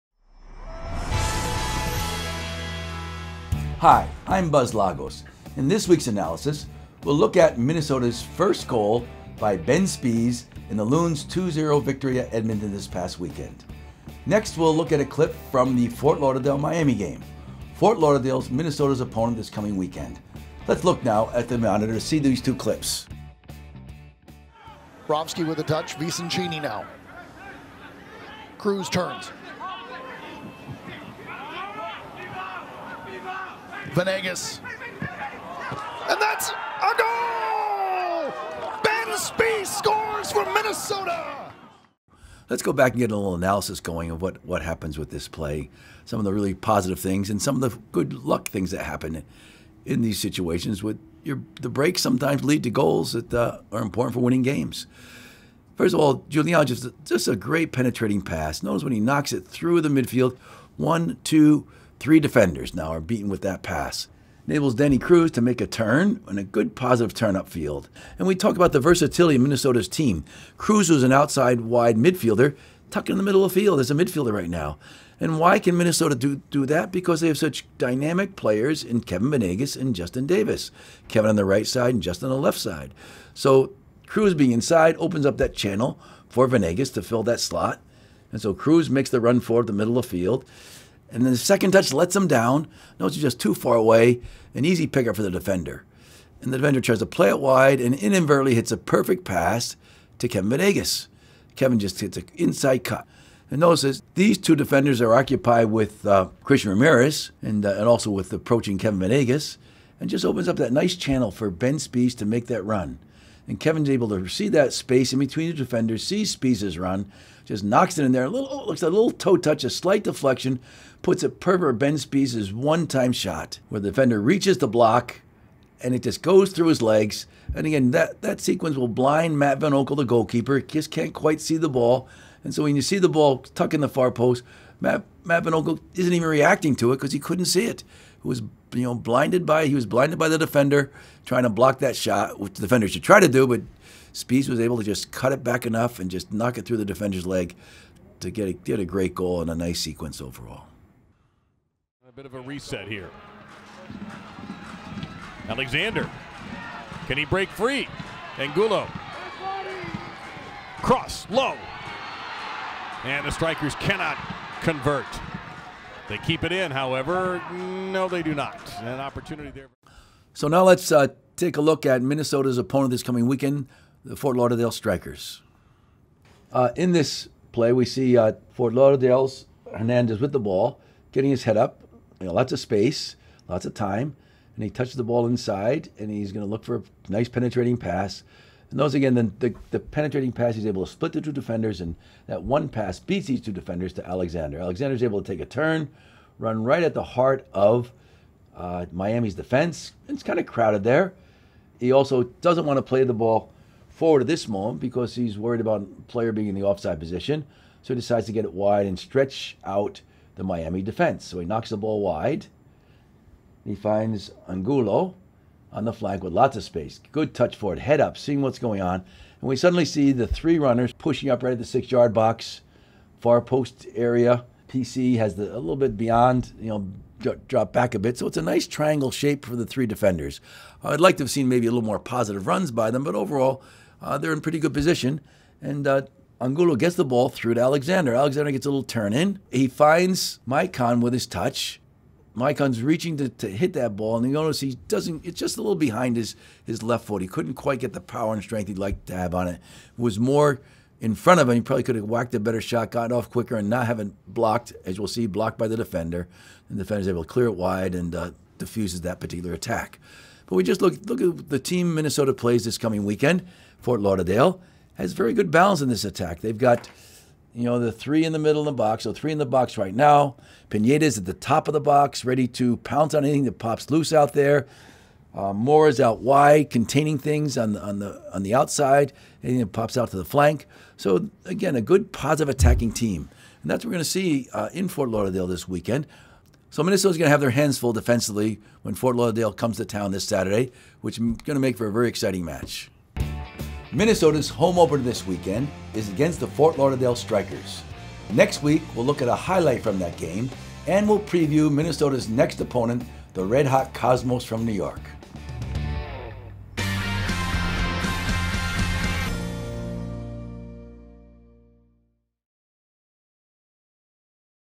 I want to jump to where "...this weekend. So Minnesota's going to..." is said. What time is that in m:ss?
4:45.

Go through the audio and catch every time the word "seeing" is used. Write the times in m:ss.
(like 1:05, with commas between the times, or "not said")
3:38.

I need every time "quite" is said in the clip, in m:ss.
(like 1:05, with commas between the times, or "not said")
2:11, 4:07.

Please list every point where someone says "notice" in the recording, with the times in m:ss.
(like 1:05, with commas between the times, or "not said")
0:58, 1:43, 4:04.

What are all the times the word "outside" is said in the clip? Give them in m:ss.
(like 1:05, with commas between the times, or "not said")
1:11, 4:38.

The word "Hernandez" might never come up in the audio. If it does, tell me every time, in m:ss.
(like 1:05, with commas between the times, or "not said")
2:59.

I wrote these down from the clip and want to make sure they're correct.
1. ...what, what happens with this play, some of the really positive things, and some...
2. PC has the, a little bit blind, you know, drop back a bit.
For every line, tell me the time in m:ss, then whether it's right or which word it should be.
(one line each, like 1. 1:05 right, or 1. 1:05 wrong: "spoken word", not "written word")
1. 0:44 right
2. 3:44 wrong: "beyond", not "blind".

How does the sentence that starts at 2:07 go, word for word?
And again, that, that sequence will blind Matt Van Oekel, the goalkeeper.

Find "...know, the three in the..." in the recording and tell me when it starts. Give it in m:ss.
4:27.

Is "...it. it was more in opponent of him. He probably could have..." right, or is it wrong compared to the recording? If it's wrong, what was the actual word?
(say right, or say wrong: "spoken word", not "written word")
wrong: "front", not "opponent".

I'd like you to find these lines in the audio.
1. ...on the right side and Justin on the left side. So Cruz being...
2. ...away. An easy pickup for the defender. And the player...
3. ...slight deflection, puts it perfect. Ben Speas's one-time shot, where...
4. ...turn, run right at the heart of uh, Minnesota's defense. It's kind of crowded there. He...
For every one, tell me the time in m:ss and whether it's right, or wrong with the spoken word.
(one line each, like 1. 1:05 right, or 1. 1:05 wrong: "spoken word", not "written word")
1. 1:21 right
2. 1:33 wrong: "defender", not "player"
3. 1:59 right
4. 3:15 wrong: "Miami", not "Minnesota".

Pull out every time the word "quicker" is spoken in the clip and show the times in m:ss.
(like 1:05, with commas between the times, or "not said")
4:13.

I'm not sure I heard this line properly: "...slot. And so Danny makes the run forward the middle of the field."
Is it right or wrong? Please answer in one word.
wrong.